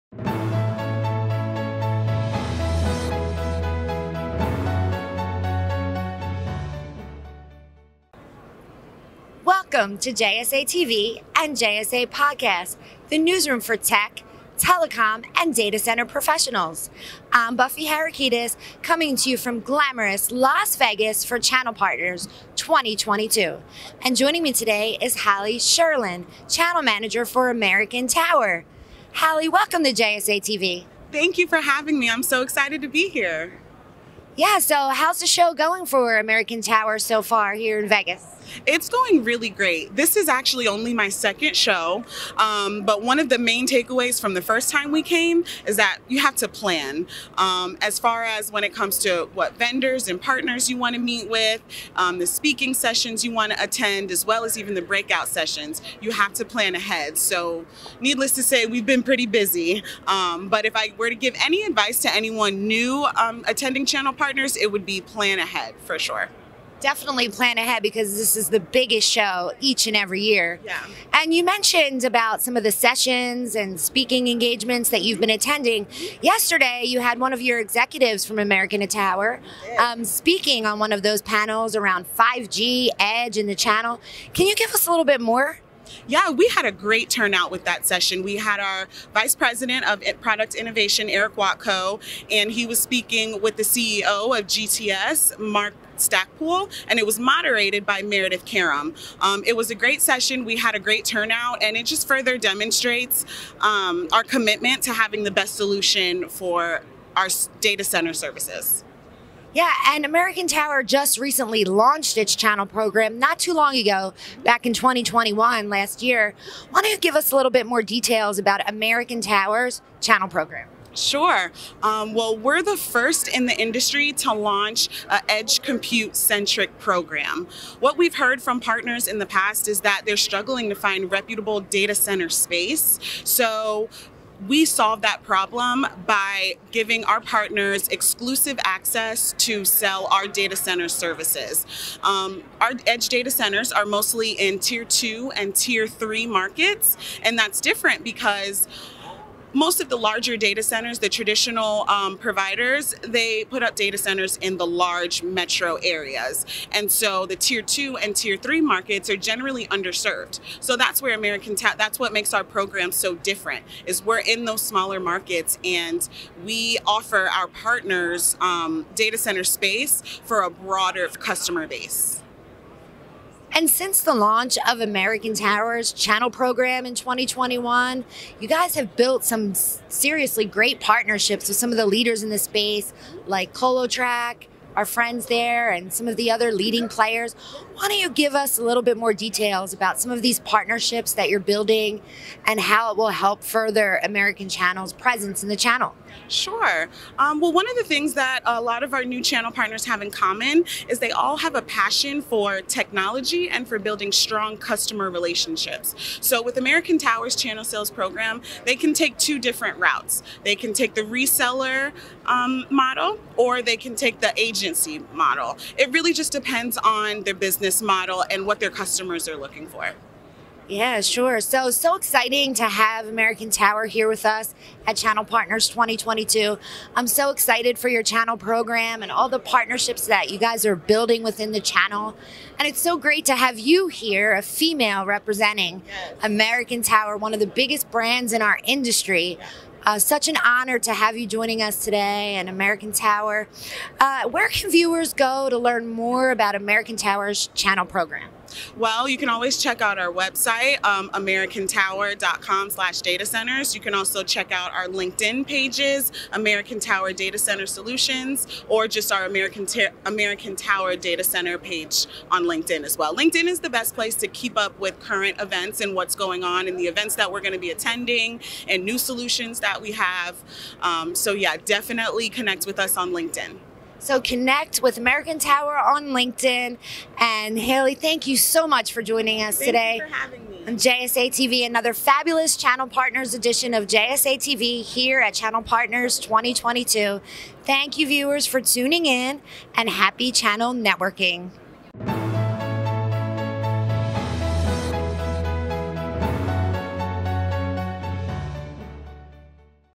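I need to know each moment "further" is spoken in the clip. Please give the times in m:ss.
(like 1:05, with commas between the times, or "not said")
1:42, 3:13.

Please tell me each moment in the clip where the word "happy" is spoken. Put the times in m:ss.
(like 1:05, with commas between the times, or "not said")
4:49.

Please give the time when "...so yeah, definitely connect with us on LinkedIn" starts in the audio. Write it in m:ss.
4:31.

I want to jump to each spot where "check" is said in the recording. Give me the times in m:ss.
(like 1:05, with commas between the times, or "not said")
4:09, 4:14.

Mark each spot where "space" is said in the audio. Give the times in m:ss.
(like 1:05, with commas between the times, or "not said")
2:12, 2:49, 3:02.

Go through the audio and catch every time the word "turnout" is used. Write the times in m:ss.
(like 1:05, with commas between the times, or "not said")
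1:27, 1:41.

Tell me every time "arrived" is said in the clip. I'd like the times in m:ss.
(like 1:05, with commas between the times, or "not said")
not said.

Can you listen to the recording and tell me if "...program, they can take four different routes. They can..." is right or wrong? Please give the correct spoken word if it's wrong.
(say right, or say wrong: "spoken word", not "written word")
wrong: "two", not "four".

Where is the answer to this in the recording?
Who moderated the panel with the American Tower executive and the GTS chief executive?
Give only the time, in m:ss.
1:38.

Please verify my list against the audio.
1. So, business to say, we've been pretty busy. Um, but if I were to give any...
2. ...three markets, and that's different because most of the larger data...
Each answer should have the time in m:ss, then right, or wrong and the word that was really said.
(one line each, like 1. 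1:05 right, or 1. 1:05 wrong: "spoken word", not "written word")
1. 0:57 wrong: "needless", not "business"
2. 2:25 right.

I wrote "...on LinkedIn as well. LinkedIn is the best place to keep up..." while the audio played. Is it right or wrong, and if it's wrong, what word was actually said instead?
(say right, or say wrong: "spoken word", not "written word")
right.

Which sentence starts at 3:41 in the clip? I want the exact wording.
So, so exciting to have American Tower here with us at Channel Partners 2022.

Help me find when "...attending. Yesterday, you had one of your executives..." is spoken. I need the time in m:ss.
1:15.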